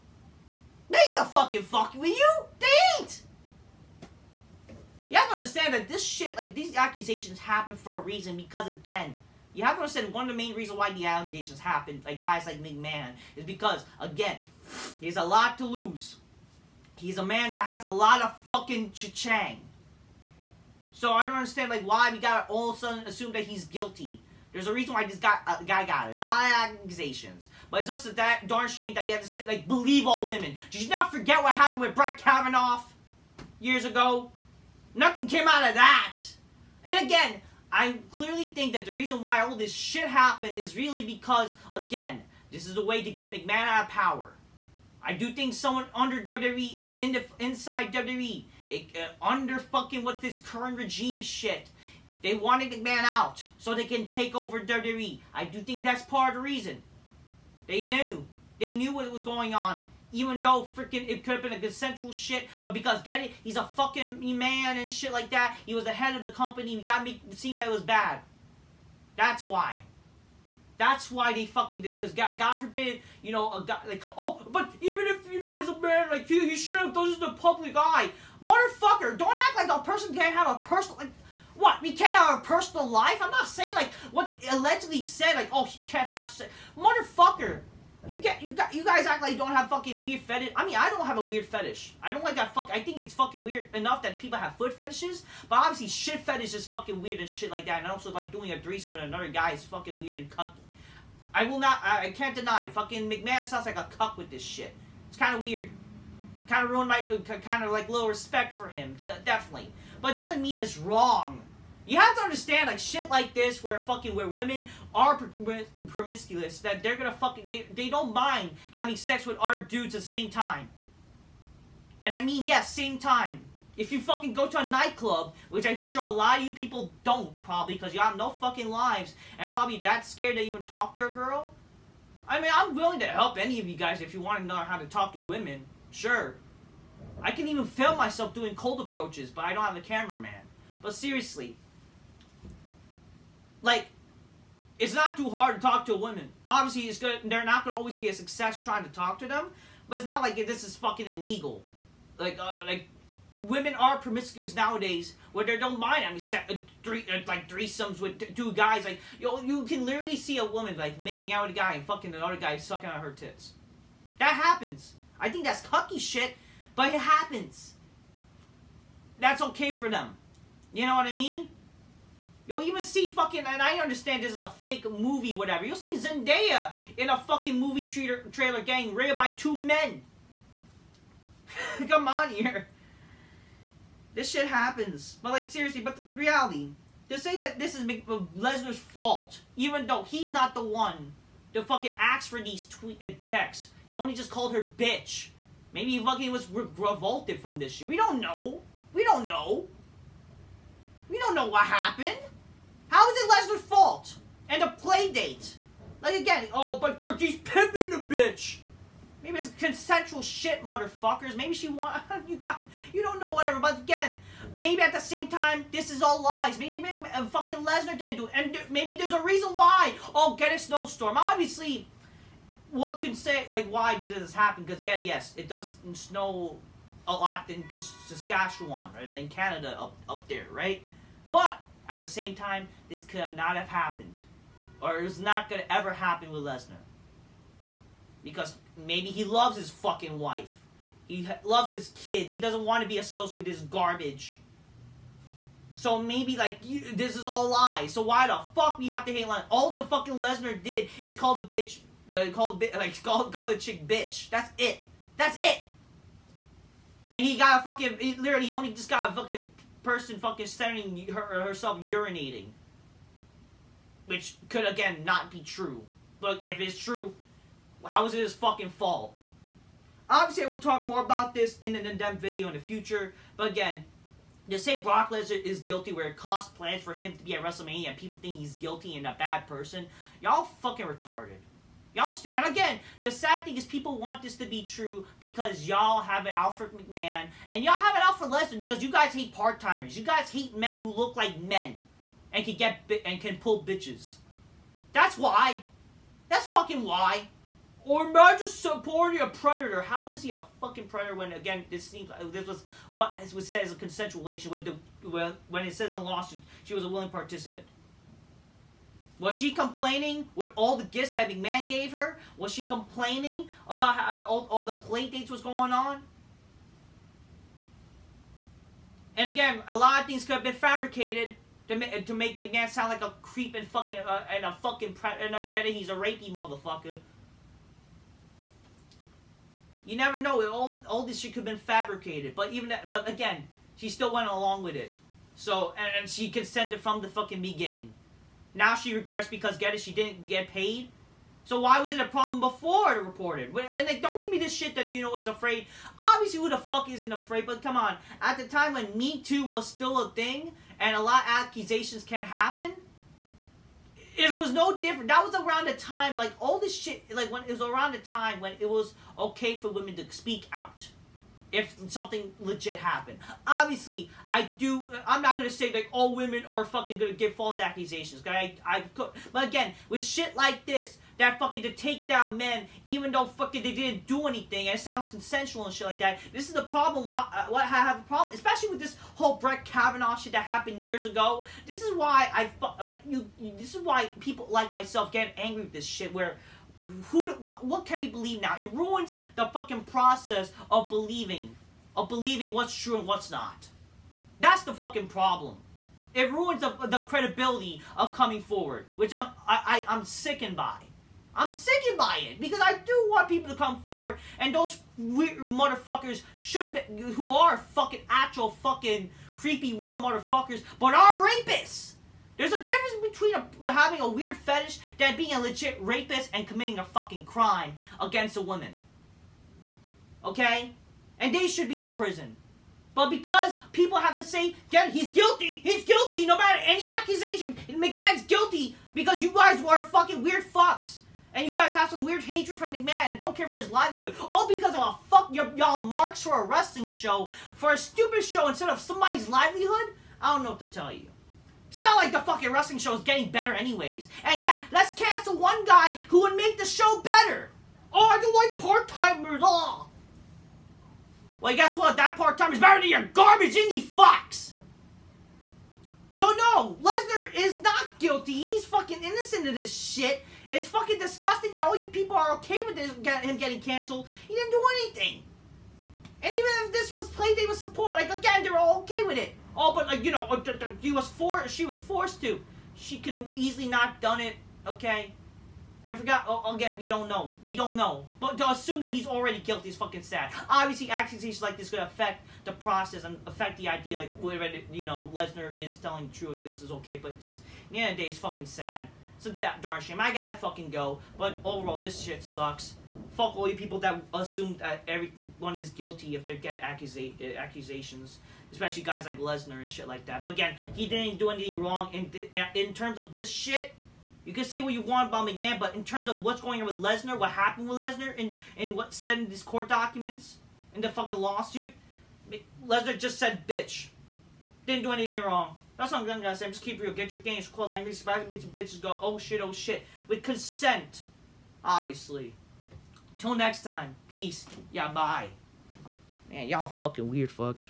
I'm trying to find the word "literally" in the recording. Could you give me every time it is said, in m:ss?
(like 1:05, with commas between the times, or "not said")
2:39, 4:18.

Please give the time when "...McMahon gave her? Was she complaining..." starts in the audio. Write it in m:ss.
5:11.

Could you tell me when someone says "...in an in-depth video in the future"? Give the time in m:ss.
4:31.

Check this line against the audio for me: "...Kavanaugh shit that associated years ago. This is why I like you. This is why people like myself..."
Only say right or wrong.
wrong.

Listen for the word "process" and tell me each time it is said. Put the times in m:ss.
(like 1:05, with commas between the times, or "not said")
6:29, 8:02.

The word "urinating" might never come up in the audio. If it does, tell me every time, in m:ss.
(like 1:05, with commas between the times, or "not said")
4:21.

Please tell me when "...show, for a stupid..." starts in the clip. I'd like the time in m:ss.
7:16.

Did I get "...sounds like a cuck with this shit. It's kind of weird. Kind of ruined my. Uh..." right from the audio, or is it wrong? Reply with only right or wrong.
right.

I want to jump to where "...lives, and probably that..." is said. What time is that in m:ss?
2:08.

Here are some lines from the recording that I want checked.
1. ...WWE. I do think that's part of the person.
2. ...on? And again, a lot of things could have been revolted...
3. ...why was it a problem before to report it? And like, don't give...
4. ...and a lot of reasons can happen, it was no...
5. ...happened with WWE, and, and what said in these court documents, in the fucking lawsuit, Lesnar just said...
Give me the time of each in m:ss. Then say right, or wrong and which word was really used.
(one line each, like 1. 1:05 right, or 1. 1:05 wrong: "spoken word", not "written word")
1. 0:54 wrong: "reason", not "person"
2. 5:15 wrong: "fabricated", not "revolted"
3. 5:41 right
4. 5:50 wrong: "accusations", not "reasons"
5. 8:27 wrong: "Lesnar", not "WWE".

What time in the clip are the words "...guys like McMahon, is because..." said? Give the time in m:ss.
0:12.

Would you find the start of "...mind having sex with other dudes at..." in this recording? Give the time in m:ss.
1:58.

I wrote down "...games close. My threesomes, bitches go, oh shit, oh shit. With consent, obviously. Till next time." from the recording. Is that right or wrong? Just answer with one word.
wrong.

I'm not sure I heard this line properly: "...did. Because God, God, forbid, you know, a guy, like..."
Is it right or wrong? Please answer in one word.
right.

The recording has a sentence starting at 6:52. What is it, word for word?
There's a difference between a, having a weird fetish than being a legit rapist and committing a fucking crime against a woman.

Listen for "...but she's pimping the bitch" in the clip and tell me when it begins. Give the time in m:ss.
3:26.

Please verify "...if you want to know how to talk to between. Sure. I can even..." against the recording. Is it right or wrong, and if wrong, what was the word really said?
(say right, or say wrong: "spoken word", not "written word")
wrong: "women", not "between".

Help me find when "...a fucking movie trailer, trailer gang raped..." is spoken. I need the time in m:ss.
2:57.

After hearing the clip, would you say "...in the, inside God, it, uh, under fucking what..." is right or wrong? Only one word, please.
wrong.